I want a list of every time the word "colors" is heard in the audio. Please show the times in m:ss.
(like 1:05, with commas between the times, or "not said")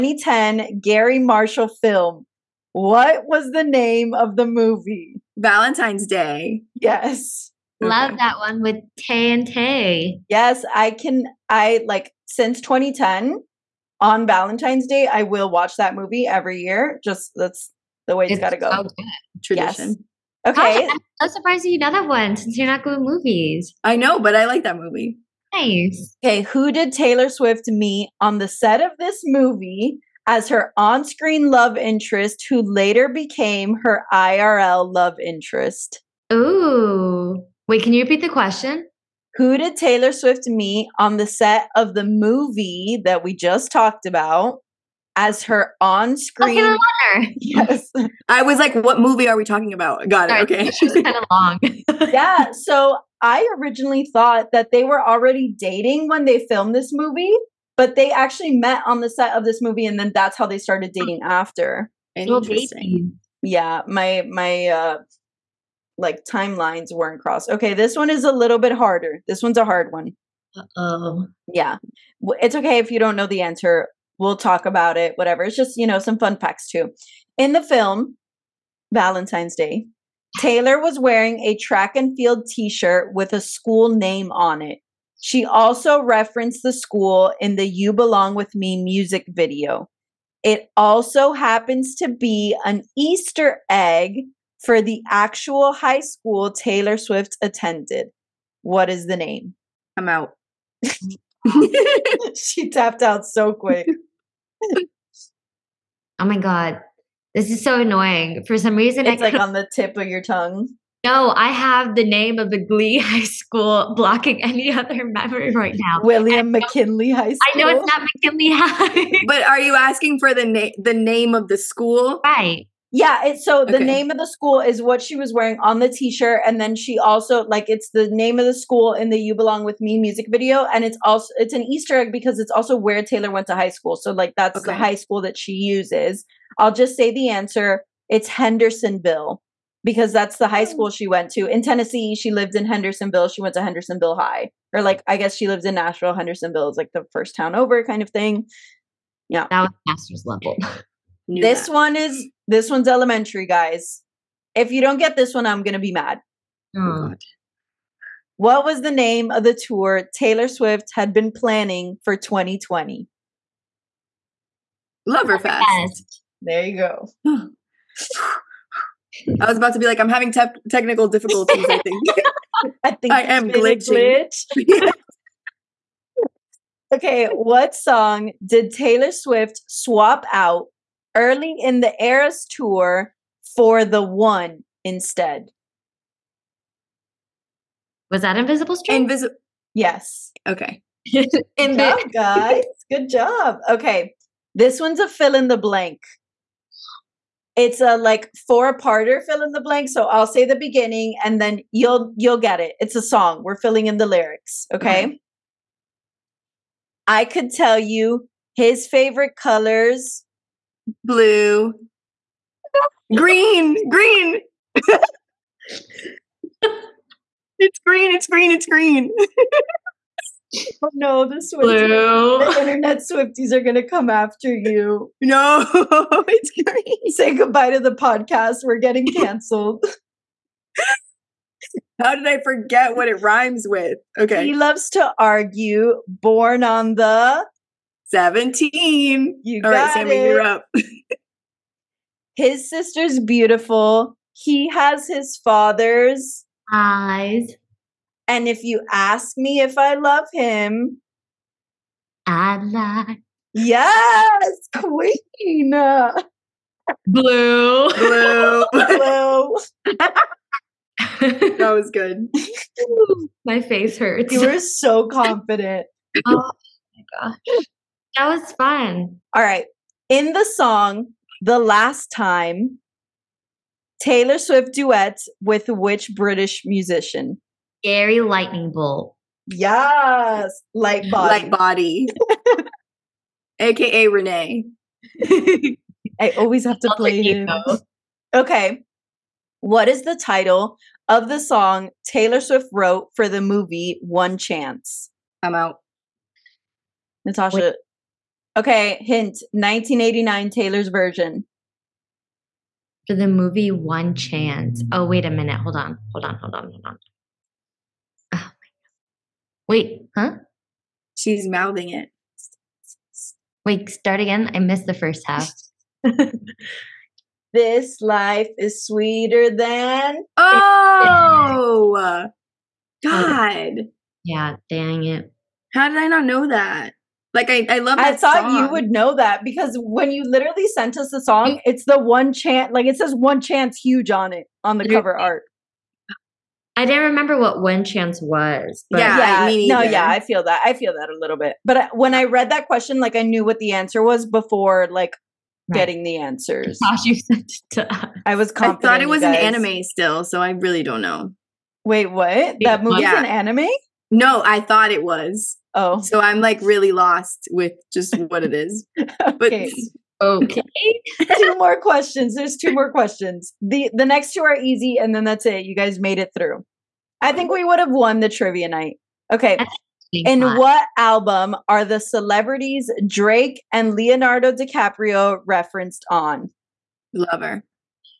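3:29.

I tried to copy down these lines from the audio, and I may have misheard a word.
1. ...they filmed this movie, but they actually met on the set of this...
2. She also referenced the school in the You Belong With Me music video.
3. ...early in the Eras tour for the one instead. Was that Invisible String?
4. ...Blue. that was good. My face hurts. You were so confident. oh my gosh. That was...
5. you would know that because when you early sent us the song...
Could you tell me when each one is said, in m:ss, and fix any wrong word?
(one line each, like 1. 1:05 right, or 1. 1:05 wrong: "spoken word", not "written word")
1. 0:56 right
2. 1:25 right
3. 3:01 right
4. 4:19 right
5. 5:28 wrong: "literally", not "early".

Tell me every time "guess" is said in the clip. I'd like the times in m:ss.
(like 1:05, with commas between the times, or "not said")
2:25.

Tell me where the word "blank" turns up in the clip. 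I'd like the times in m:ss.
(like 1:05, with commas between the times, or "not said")
3:15, 3:19.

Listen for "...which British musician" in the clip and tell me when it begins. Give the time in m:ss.
4:35.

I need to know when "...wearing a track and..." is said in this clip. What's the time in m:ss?
1:20.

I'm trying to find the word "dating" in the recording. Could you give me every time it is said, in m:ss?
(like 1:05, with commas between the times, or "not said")
0:55, 1:00.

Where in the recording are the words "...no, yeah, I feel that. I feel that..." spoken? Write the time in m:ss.
5:39.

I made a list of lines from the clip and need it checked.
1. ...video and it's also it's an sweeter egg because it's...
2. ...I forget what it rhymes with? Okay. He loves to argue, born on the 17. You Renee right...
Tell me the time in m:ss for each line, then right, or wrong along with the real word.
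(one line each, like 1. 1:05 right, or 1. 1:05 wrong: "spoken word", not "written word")
1. 2:10 wrong: "easter", not "sweeter"
2. 3:52 wrong: "All", not "Renee".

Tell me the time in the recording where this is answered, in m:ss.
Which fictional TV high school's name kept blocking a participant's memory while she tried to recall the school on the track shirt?
1:56.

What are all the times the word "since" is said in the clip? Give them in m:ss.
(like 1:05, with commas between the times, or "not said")
0:12, 0:22.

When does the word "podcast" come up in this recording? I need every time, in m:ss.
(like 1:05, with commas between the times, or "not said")
3:47.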